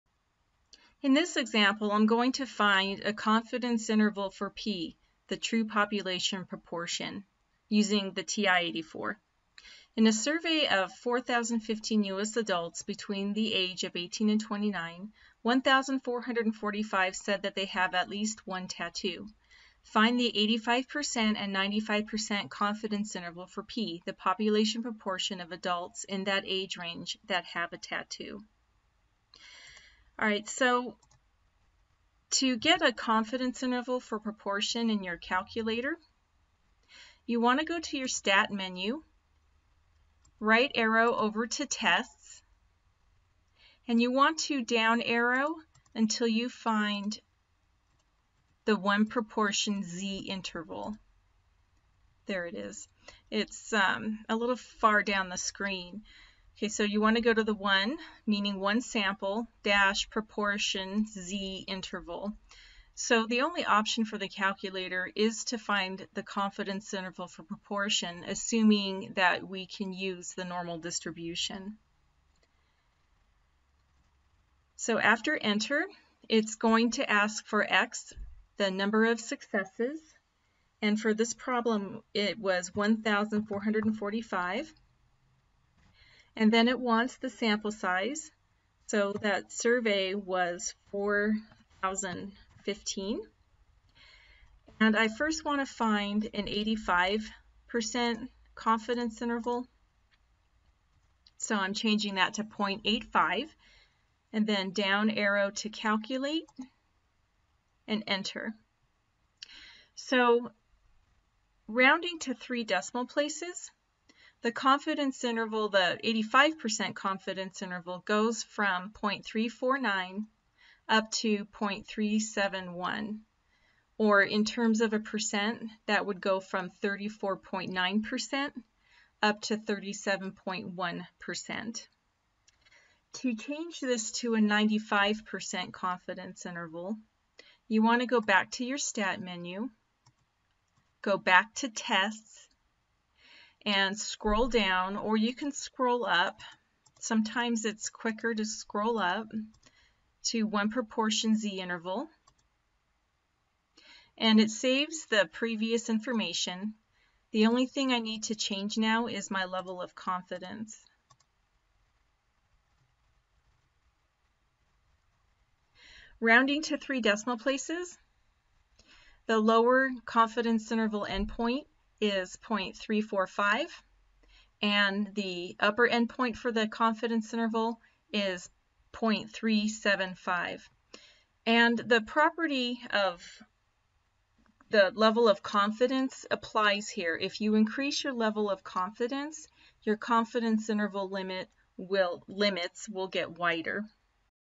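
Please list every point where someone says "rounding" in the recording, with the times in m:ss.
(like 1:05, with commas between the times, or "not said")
1:51, 2:46.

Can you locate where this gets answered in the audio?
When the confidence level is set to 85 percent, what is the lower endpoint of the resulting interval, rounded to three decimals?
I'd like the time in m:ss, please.
1:58.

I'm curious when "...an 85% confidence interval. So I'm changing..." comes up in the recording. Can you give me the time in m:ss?
1:36.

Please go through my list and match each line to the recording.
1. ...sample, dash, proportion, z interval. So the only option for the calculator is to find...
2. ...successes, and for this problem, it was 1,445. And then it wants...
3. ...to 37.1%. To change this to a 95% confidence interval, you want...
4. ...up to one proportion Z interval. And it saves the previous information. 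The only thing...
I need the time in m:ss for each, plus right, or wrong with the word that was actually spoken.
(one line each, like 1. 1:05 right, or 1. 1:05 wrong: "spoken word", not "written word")
1. 0:58 right
2. 1:19 right
3. 2:09 right
4. 2:28 right.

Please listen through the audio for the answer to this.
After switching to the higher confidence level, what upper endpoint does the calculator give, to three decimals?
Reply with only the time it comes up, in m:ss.
2:58.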